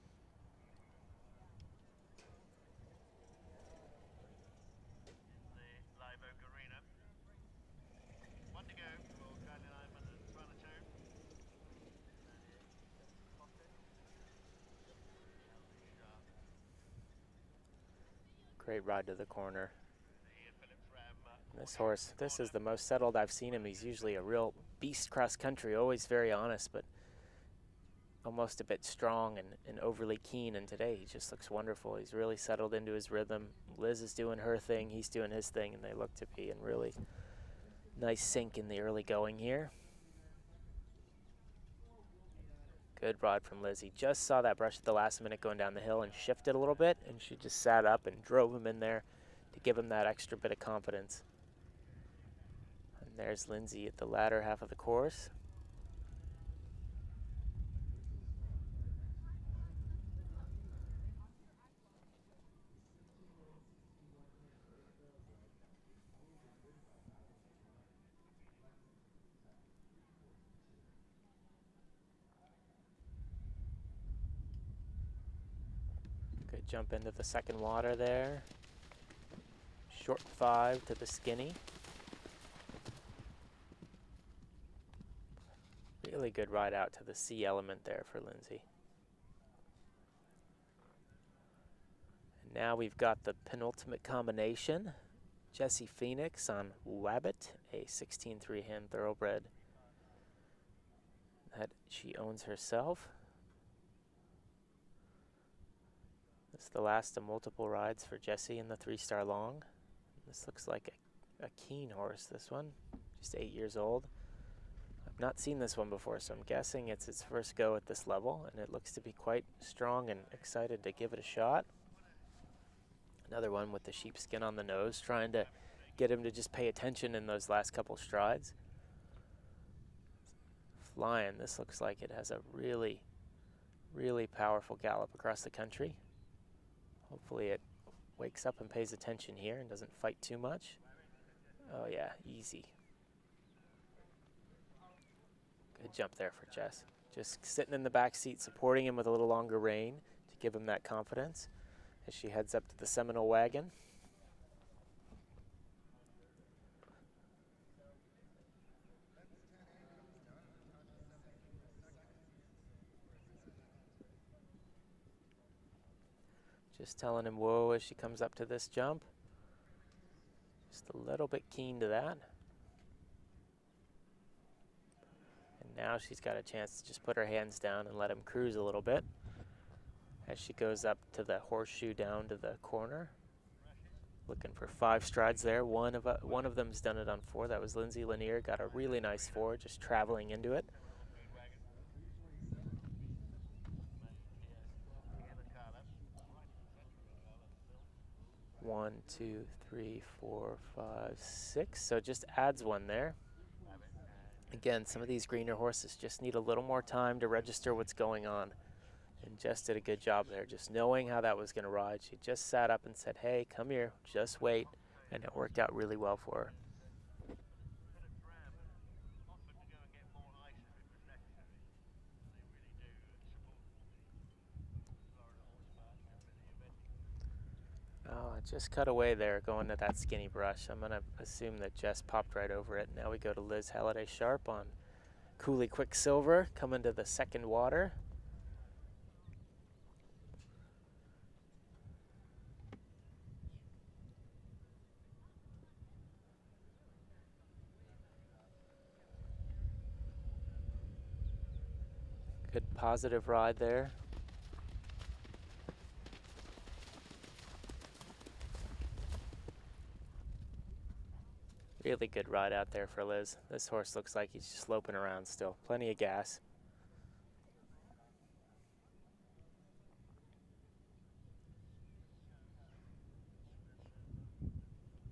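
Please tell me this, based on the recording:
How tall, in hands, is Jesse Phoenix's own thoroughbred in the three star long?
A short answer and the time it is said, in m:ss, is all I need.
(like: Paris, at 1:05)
16-3, at 1:37.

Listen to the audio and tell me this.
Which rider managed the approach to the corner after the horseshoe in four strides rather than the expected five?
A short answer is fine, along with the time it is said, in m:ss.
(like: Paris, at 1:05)
Lindsay Lanier, at 3:07.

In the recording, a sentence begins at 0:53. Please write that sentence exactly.
And there's Lindsay at the latter half of the course.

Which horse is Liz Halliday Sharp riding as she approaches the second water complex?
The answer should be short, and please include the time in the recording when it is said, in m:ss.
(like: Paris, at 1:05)
Cooley Quicksilver, at 3:55.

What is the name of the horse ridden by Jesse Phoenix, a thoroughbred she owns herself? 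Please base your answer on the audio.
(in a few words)
Wabbit.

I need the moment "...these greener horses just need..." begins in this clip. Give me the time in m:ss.
3:25.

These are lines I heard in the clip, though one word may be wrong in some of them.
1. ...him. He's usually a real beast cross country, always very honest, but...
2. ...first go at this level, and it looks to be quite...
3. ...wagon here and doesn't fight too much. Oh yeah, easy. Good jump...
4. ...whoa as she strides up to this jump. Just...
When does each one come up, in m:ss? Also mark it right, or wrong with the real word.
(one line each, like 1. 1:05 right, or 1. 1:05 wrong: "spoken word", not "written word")
1. 0:23 right
2. 1:57 right
3. 2:18 wrong: "attention", not "wagon"
4. 2:47 wrong: "comes", not "strides".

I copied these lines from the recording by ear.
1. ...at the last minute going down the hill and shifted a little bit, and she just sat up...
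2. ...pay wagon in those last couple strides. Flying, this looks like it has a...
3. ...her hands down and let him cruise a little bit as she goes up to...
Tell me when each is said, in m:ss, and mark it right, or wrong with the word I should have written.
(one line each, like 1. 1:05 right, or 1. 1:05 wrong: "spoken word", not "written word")
1. 0:44 right
2. 2:06 wrong: "attention", not "wagon"
3. 2:57 right.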